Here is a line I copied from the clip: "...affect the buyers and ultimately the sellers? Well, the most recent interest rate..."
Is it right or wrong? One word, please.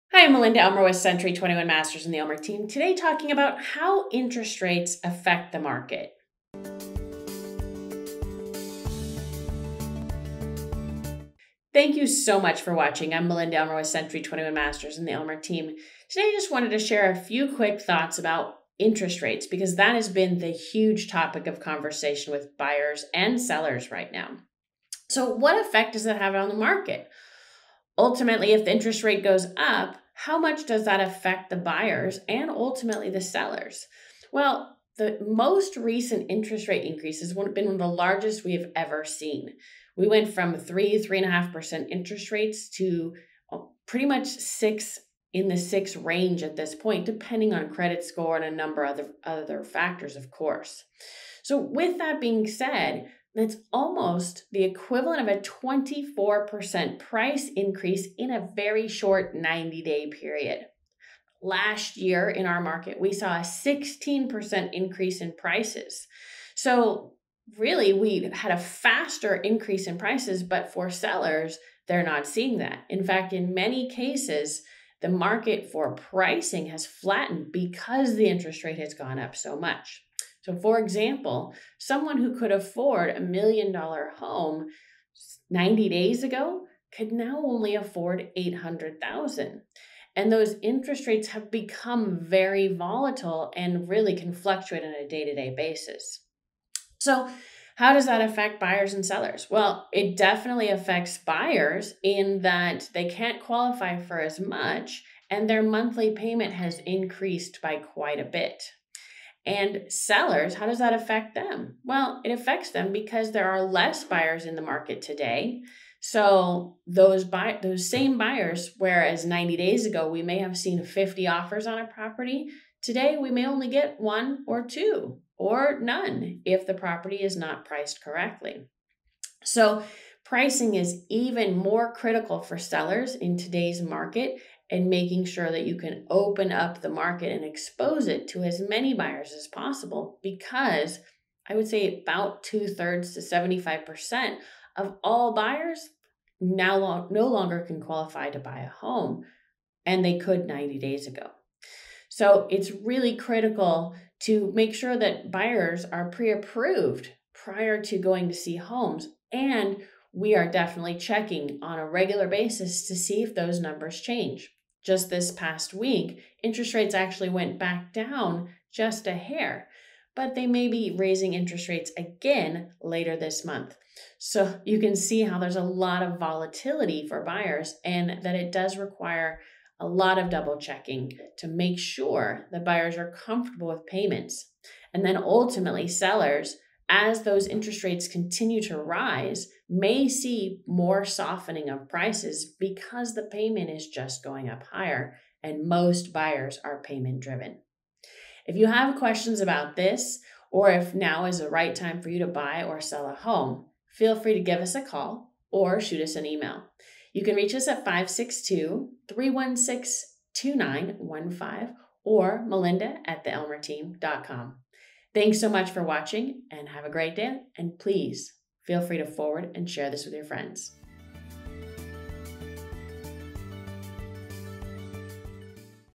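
right.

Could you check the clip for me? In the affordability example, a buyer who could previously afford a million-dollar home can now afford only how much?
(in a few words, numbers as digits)
800,000.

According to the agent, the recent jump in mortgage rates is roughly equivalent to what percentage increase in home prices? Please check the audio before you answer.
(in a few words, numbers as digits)
24%.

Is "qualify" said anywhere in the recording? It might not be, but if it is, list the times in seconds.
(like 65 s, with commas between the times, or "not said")
103 s, 147 s.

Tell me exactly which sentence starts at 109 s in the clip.
And sellers, how does that affect them?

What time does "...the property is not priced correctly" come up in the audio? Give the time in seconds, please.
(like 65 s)
126 s.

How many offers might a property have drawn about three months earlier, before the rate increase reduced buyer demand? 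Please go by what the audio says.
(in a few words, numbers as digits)
50.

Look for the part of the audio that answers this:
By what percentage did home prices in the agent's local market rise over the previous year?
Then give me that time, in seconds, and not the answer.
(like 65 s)
63 s.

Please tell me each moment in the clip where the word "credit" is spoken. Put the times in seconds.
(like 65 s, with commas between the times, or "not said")
47 s.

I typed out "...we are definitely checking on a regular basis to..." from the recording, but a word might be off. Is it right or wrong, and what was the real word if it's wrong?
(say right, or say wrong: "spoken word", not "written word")
right.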